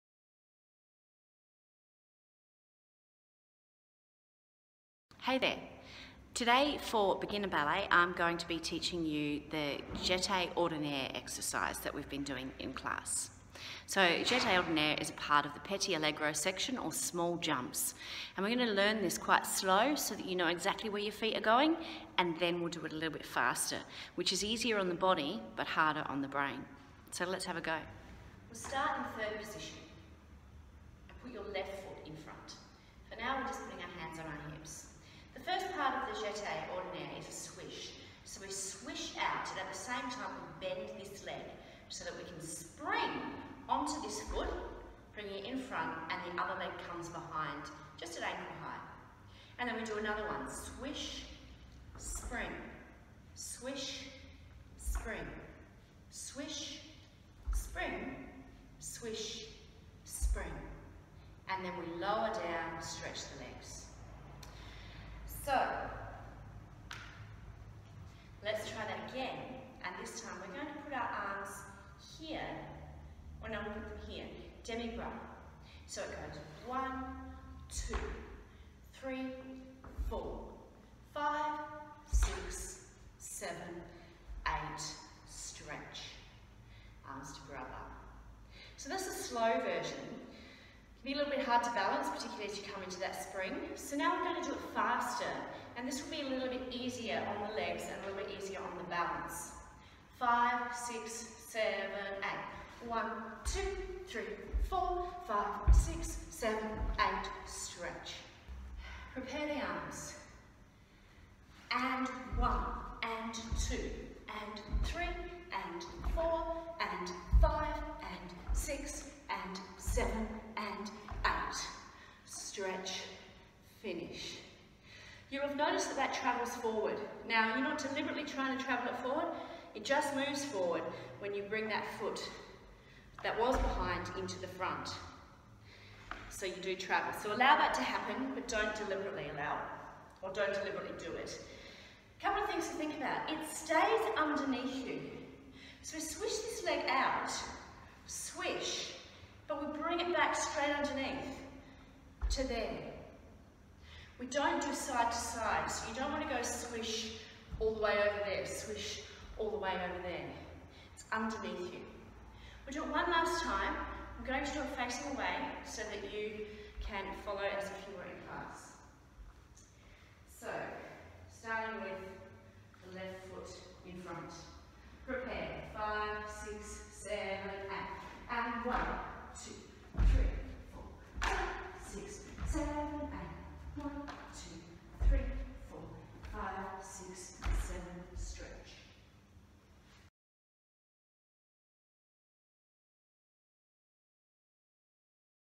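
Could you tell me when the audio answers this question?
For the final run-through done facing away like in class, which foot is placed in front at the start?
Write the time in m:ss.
2:52.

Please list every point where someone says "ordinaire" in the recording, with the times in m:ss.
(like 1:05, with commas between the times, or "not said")
0:10, 0:14, 0:36.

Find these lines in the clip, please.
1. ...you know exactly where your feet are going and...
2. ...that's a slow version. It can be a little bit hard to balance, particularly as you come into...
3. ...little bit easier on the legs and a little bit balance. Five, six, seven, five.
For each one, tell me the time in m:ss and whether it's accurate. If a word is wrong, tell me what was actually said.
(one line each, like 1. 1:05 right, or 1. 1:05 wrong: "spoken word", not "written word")
1. 0:20 right
2. 1:28 right
3. 1:36 wrong: "eight", not "five".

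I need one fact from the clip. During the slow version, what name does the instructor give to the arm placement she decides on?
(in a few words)
demi-bras.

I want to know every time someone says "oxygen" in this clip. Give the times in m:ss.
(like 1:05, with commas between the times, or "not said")
not said.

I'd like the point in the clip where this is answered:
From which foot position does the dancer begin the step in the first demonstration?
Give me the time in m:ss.
0:29.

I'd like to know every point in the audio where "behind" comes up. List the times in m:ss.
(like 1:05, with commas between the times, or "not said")
0:47, 2:13.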